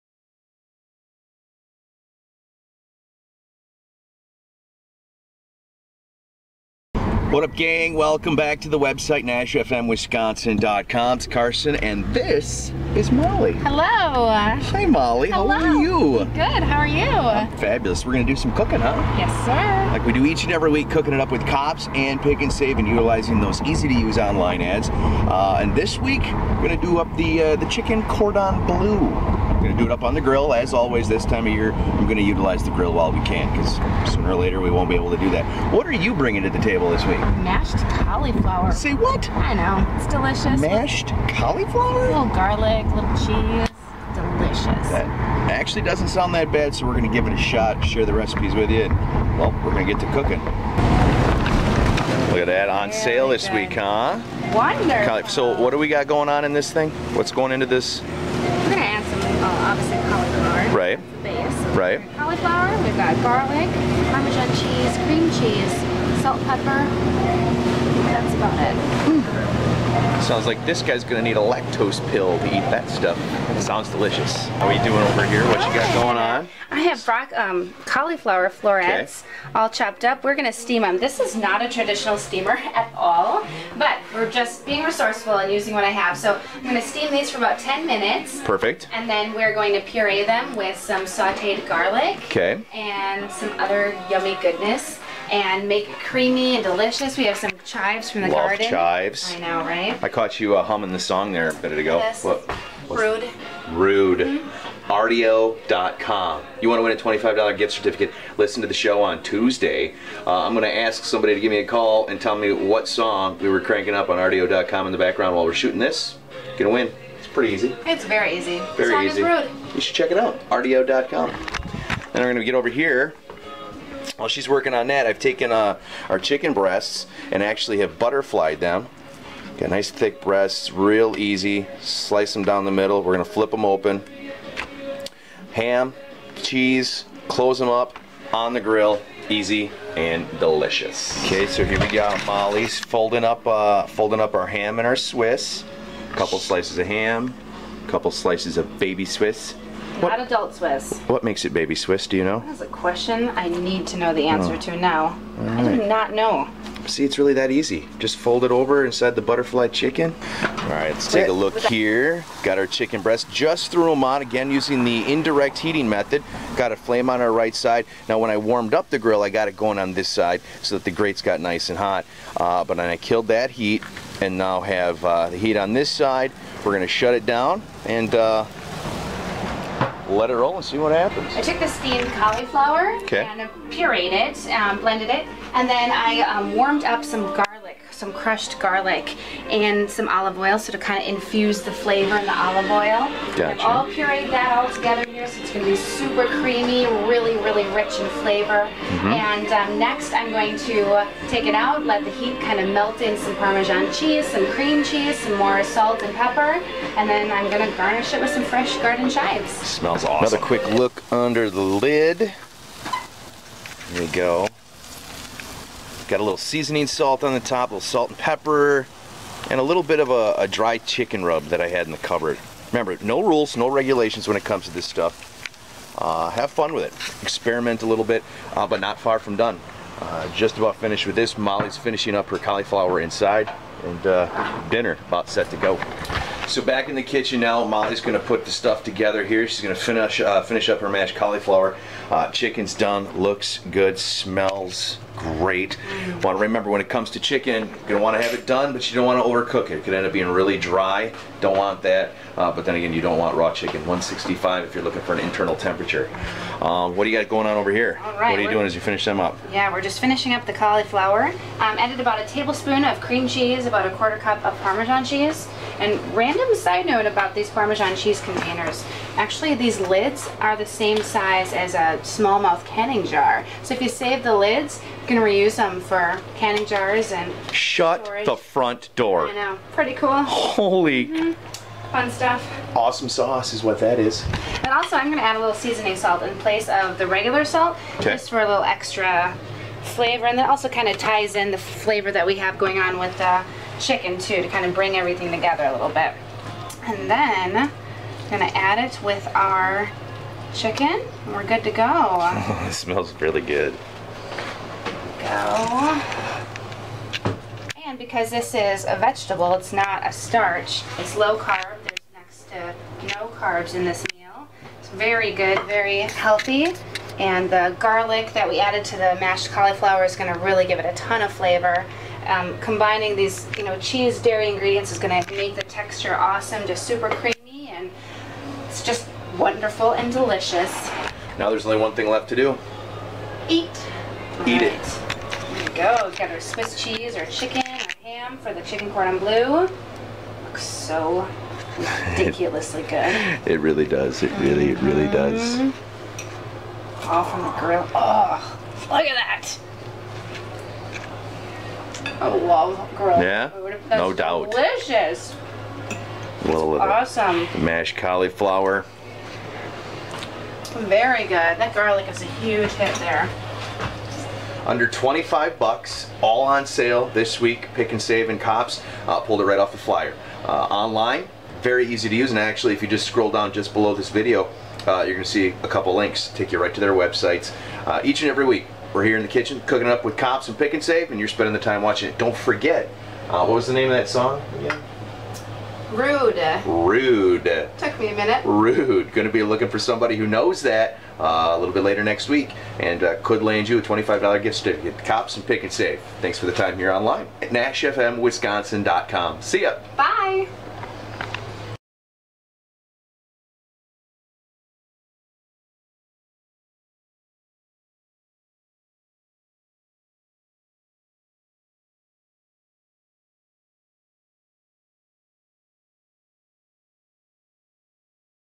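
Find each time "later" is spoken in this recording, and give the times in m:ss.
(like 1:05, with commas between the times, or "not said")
0:34, 6:31.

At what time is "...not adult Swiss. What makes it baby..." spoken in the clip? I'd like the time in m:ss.
2:30.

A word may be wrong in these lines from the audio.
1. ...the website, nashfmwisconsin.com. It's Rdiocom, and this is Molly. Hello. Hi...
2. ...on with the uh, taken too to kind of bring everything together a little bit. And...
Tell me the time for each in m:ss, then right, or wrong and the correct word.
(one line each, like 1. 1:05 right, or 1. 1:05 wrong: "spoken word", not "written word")
1. 0:08 wrong: "Carson", not "Rdiocom"
2. 4:52 wrong: "chicken", not "taken".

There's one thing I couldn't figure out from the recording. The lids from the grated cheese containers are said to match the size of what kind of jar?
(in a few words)
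Smallmouth canning jar.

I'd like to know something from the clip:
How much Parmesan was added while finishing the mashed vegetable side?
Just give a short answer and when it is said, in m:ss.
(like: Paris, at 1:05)
A quarter cup, at 4:23.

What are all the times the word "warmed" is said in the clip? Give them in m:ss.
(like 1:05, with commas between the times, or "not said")
2:48, 3:06.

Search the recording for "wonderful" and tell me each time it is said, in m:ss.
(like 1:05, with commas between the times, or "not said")
0:54, 5:29.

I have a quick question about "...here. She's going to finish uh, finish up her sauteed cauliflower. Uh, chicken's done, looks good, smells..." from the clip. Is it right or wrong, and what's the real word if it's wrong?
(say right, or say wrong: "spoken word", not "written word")
wrong: "mashed", not "sauteed".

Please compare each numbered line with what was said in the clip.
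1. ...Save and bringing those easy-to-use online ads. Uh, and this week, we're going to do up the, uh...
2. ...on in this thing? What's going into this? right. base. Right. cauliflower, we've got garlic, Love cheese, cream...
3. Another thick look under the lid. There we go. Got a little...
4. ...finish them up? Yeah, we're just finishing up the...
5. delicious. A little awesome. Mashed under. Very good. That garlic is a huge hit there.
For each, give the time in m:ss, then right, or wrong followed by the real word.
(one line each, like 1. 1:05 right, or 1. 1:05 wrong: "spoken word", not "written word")
1. 0:22 wrong: "utilizing", not "bringing"
2. 0:56 wrong: "Parmesan", not "Love"
3. 3:30 wrong: "quick", not "thick"
4. 4:18 right
5. 5:54 wrong: "cauliflower", not "under".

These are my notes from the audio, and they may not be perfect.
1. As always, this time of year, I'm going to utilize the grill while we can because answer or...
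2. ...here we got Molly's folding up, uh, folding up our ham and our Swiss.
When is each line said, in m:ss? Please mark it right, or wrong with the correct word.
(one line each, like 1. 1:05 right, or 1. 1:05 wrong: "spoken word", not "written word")
1. 0:30 wrong: "sooner", not "answer"
2. 2:21 right.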